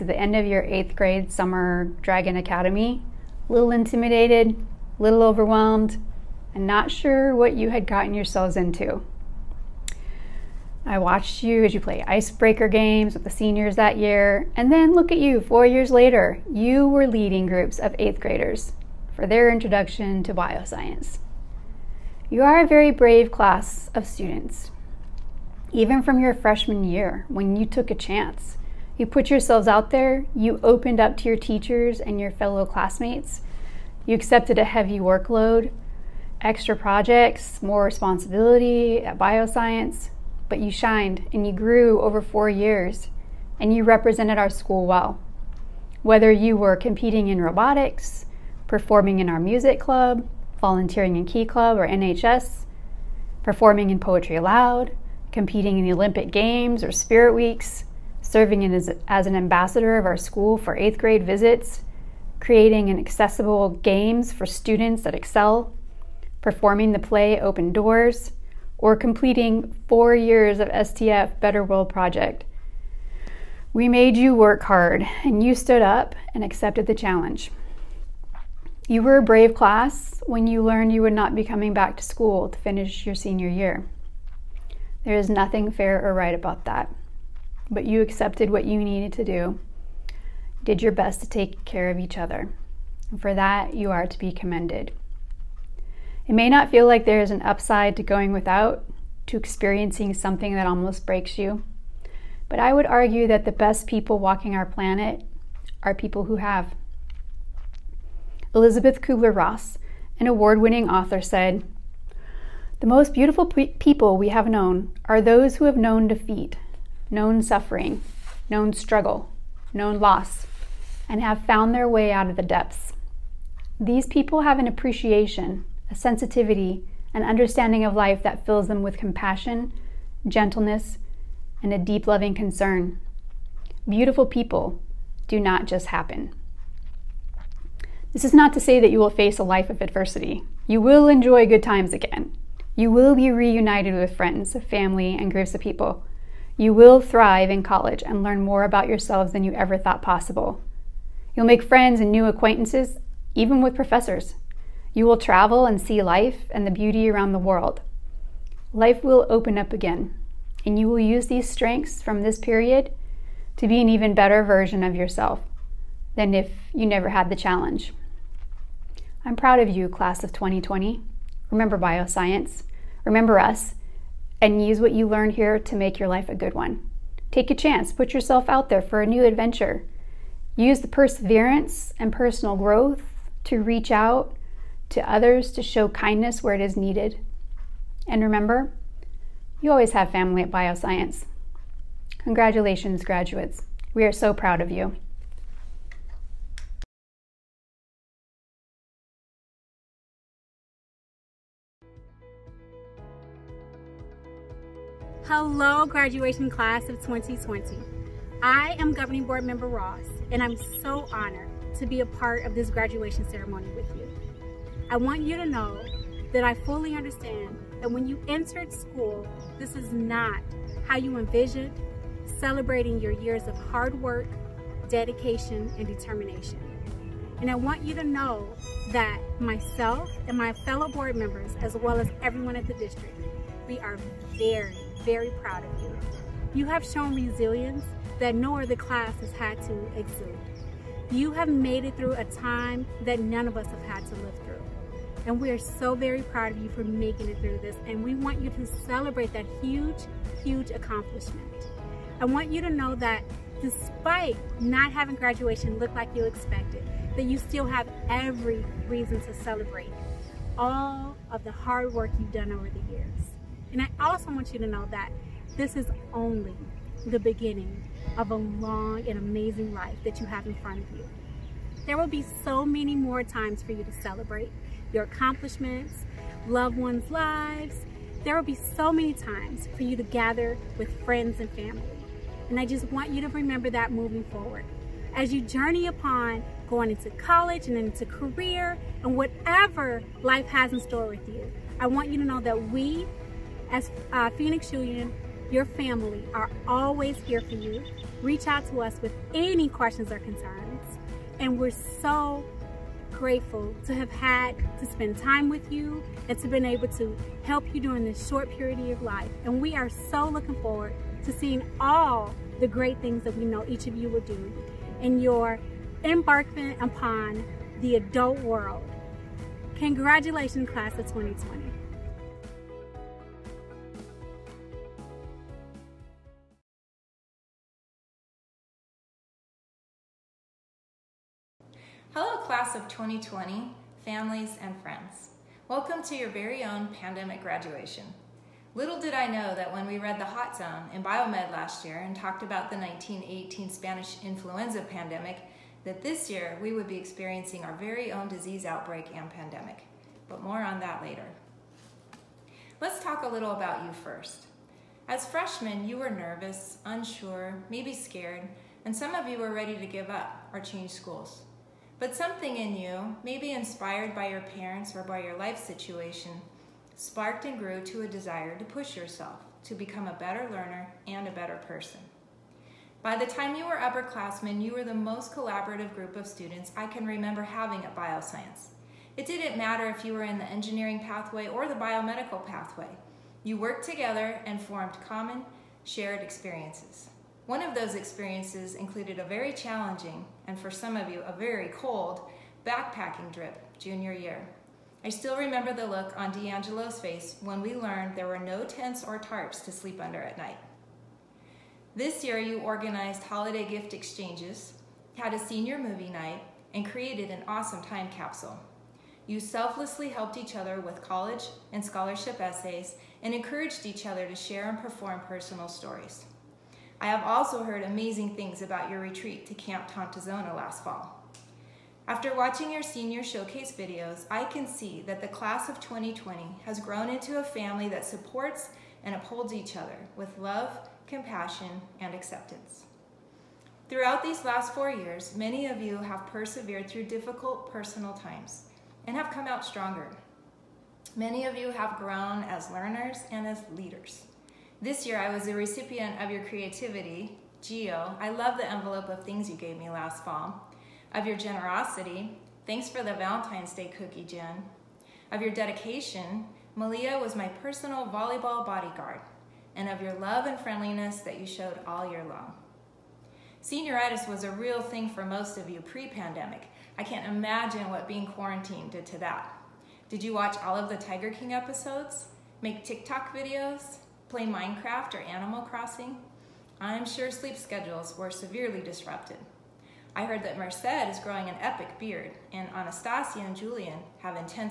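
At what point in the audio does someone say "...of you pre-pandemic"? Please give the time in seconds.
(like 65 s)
465 s.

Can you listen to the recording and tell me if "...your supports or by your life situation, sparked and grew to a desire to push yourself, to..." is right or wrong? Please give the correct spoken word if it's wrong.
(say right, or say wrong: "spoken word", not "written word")
wrong: "parents", not "supports".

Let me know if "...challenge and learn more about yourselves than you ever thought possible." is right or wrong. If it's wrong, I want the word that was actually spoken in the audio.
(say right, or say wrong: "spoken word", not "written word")
wrong: "college", not "challenge".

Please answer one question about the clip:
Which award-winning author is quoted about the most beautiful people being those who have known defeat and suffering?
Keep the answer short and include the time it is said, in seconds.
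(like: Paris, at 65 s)
Elizabeth Kubler Ross, at 108 s.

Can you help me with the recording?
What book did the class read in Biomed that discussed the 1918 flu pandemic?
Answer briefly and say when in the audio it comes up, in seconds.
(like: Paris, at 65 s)
The Hot Zone, at 340 s.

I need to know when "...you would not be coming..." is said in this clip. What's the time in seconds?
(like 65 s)
80 s.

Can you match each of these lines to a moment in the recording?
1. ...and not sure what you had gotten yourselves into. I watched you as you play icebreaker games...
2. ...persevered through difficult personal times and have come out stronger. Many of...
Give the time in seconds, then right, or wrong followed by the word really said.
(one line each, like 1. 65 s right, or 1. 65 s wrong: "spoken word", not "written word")
1. 6 s right
2. 436 s right.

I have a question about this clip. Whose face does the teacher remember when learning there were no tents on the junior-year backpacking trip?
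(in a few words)
D'Angelo.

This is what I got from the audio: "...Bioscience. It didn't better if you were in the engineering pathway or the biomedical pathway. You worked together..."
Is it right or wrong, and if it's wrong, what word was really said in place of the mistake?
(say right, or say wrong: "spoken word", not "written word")
wrong: "matter", not "better".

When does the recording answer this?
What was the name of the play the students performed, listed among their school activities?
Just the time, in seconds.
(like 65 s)
67 s.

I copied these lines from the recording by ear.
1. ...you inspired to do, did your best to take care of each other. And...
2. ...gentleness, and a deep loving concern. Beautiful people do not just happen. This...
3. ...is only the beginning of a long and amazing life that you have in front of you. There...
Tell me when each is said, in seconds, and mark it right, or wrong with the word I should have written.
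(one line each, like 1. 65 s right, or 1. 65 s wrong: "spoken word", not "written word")
1. 88 s wrong: "needed", not "inspired"
2. 130 s right
3. 265 s right.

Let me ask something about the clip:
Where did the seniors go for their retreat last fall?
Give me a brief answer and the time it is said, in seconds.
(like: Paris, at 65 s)
Camp Tontozona, at 419 s.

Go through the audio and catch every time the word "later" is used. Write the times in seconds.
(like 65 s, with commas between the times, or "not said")
15 s, 351 s.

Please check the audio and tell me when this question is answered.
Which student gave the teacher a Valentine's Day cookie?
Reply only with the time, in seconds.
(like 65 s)
454 s.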